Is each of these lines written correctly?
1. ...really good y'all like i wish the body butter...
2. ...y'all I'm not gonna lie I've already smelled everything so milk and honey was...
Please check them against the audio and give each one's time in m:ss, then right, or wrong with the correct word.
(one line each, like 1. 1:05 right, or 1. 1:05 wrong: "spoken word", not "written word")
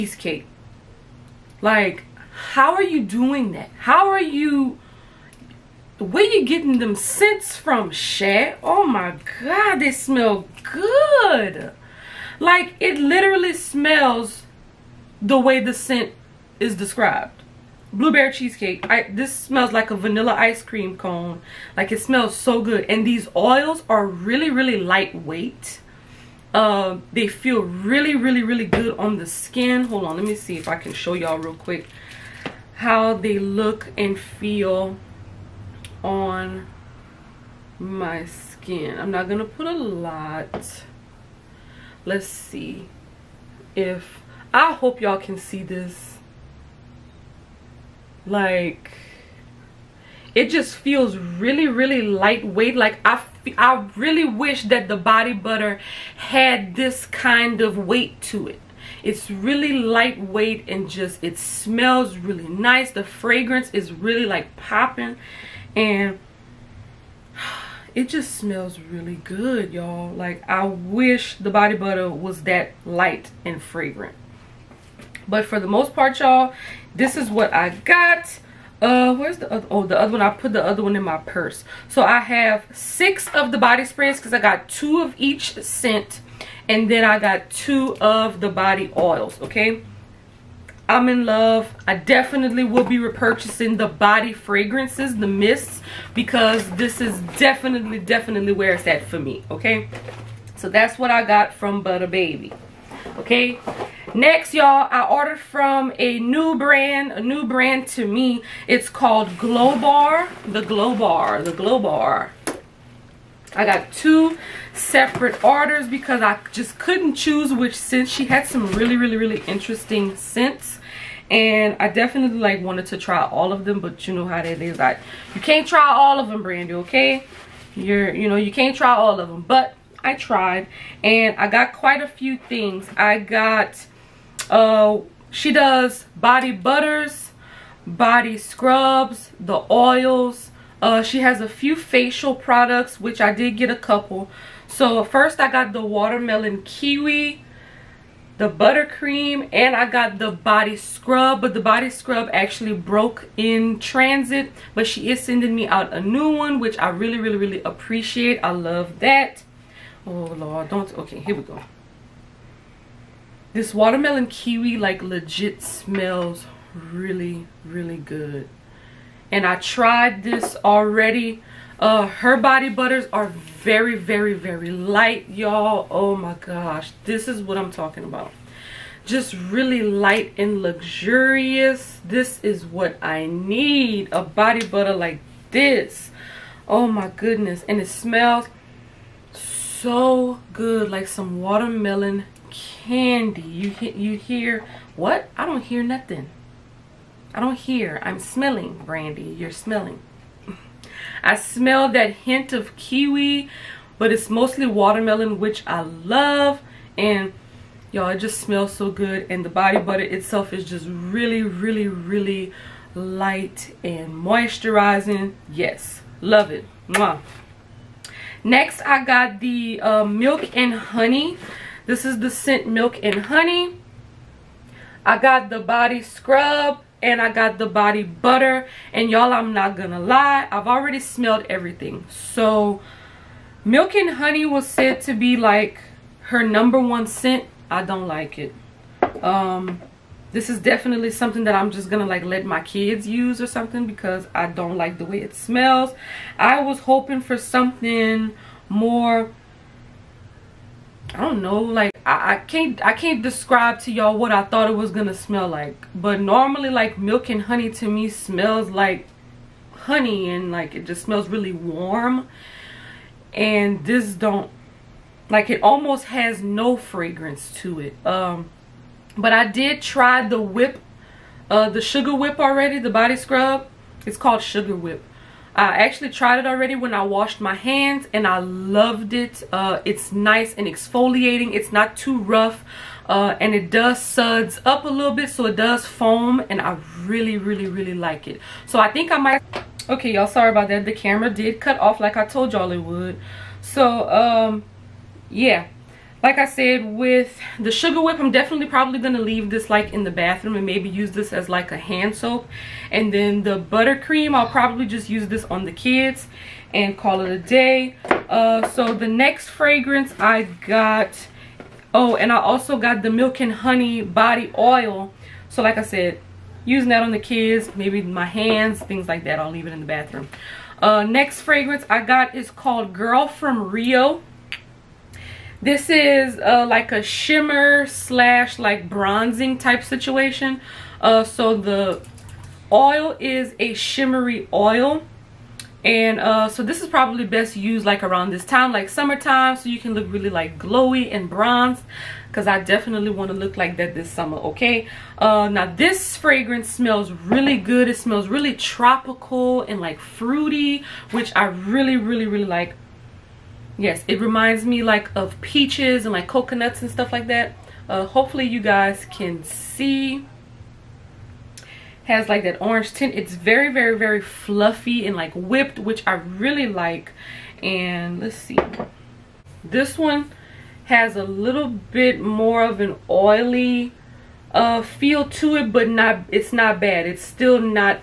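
1. 1:08 right
2. 3:49 right.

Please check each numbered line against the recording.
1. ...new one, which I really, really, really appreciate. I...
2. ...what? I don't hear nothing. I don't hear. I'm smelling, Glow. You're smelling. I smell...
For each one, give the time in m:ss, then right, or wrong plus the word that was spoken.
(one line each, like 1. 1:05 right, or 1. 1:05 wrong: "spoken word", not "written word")
1. 2:35 right
2. 3:14 wrong: "Brandy", not "Glow".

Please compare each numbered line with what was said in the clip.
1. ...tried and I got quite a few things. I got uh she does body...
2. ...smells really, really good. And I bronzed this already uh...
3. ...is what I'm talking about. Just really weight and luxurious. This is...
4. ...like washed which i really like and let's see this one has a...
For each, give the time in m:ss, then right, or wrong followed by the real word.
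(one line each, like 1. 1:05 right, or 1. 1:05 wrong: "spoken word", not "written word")
1. 2:10 right
2. 2:45 wrong: "tried", not "bronzed"
3. 2:57 wrong: "light", not "weight"
4. 6:05 wrong: "whipped", not "washed".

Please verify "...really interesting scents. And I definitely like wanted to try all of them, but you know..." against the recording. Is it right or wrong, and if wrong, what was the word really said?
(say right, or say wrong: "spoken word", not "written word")
right.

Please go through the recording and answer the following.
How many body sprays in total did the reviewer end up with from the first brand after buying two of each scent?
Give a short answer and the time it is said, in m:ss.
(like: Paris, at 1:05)
6, at 1:22.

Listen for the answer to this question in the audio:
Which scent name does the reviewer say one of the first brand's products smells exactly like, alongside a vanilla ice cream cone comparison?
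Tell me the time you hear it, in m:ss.
0:17.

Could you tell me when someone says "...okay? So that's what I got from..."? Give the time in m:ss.
1:39.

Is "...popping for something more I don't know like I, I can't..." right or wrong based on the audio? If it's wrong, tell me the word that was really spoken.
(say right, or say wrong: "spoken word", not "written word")
wrong: "hoping", not "popping".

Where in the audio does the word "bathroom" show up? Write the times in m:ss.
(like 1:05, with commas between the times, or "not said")
5:00, 5:19.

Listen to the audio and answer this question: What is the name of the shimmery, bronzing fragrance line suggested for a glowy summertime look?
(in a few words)
Girl from Rio.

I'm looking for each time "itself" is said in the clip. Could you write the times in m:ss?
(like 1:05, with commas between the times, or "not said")
3:30.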